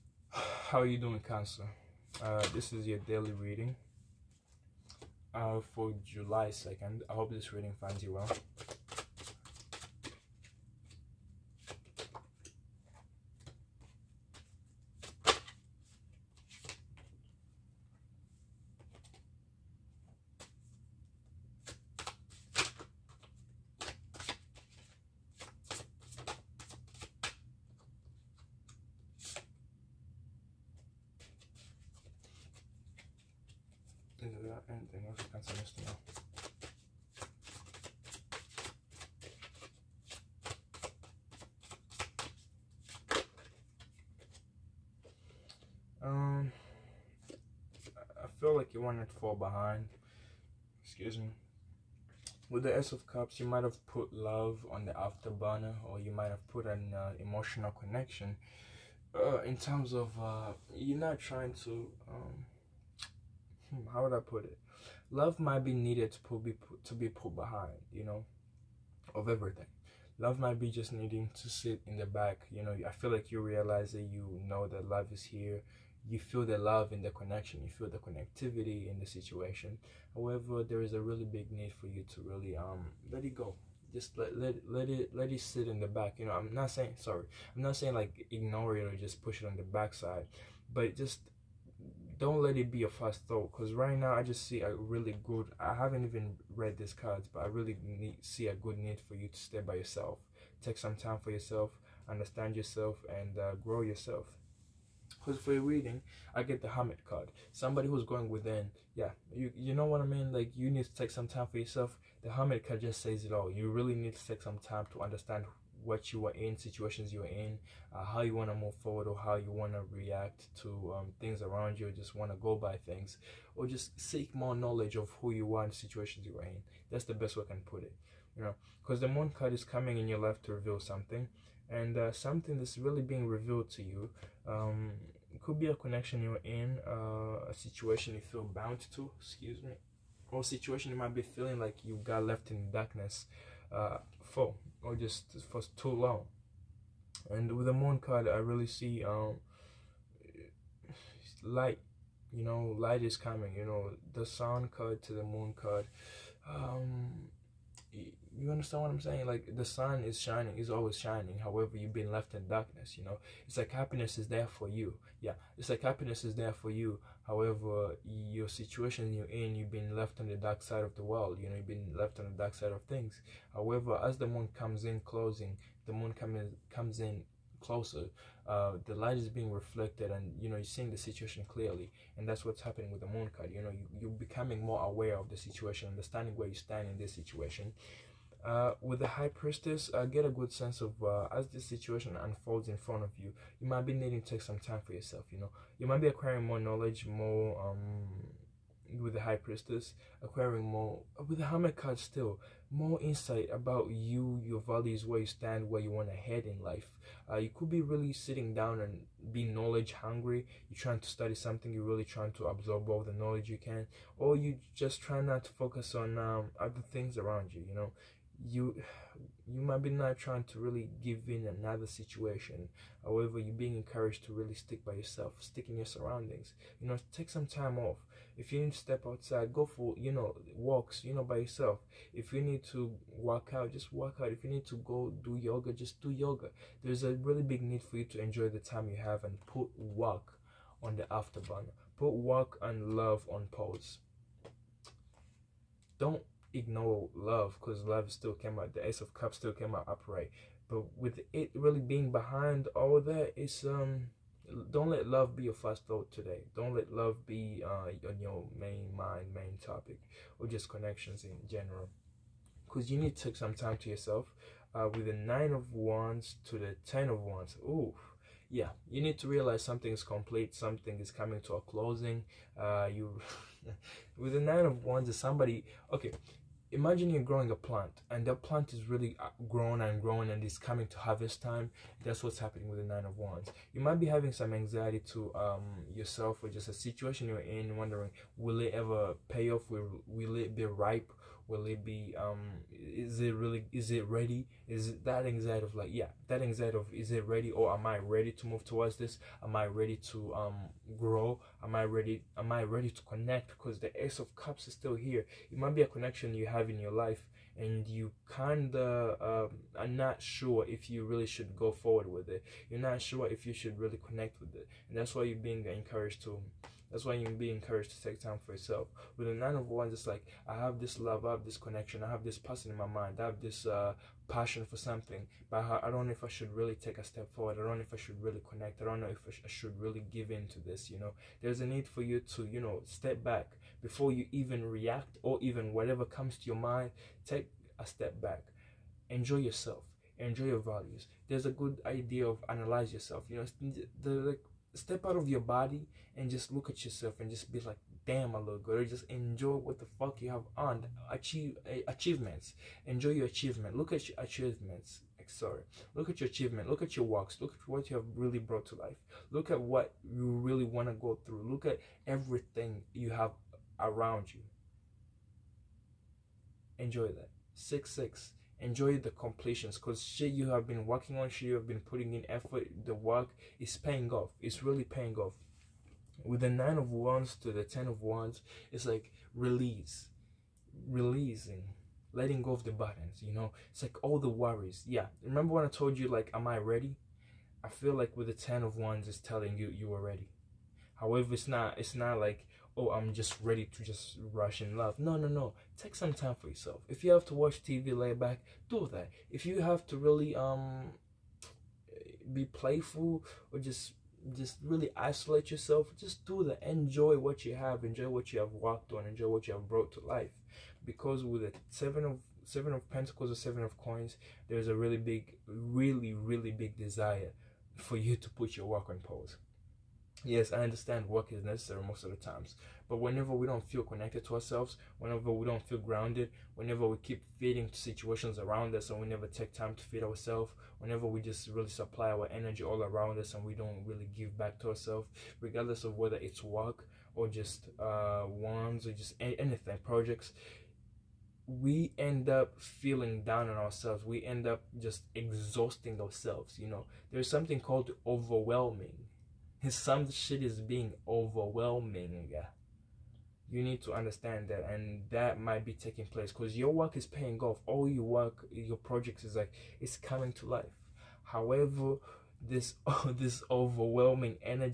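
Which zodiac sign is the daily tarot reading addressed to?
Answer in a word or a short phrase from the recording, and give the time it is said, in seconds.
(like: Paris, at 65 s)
Cancer, at 1 s.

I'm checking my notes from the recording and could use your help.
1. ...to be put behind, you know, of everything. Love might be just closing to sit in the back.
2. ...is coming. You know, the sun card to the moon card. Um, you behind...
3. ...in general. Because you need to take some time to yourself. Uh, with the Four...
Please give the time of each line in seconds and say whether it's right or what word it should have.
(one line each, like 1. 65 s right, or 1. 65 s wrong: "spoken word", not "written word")
1. 66 s wrong: "needing", not "closing"
2. 153 s wrong: "understand", not "behind"
3. 261 s wrong: "Nine", not "Four".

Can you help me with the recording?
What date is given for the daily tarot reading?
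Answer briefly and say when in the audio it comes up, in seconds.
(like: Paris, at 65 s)
July 2nd, at 6 s.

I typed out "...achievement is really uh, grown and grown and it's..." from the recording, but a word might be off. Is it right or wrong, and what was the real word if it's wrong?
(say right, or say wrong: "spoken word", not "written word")
wrong: "plant", not "achievement".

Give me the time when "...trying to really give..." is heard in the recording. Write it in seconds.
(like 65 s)
220 s.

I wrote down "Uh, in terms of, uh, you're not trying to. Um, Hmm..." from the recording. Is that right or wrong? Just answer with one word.
right.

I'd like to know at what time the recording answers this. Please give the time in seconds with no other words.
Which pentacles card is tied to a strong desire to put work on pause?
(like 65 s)
412 s.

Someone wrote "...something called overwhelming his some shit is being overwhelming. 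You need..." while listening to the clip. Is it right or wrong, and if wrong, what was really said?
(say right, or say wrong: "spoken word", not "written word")
right.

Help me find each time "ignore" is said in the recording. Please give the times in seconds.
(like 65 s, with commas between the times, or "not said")
88 s, 246 s.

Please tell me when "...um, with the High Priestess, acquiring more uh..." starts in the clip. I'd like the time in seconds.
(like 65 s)
197 s.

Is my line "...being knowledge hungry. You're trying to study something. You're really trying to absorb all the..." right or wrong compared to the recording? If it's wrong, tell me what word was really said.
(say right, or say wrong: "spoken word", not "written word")
right.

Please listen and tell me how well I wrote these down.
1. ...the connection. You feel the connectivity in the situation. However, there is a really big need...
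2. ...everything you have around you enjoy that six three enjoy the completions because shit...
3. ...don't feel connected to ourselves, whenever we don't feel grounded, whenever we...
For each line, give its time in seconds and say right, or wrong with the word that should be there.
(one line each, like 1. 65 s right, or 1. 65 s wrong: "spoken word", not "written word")
1. 77 s right
2. 362 s wrong: "six", not "three"
3. 423 s right.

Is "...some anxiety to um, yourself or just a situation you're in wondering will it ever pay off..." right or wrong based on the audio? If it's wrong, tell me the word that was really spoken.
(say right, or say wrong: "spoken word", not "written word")
right.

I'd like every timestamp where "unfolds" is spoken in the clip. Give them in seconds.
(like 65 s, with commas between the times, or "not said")
192 s.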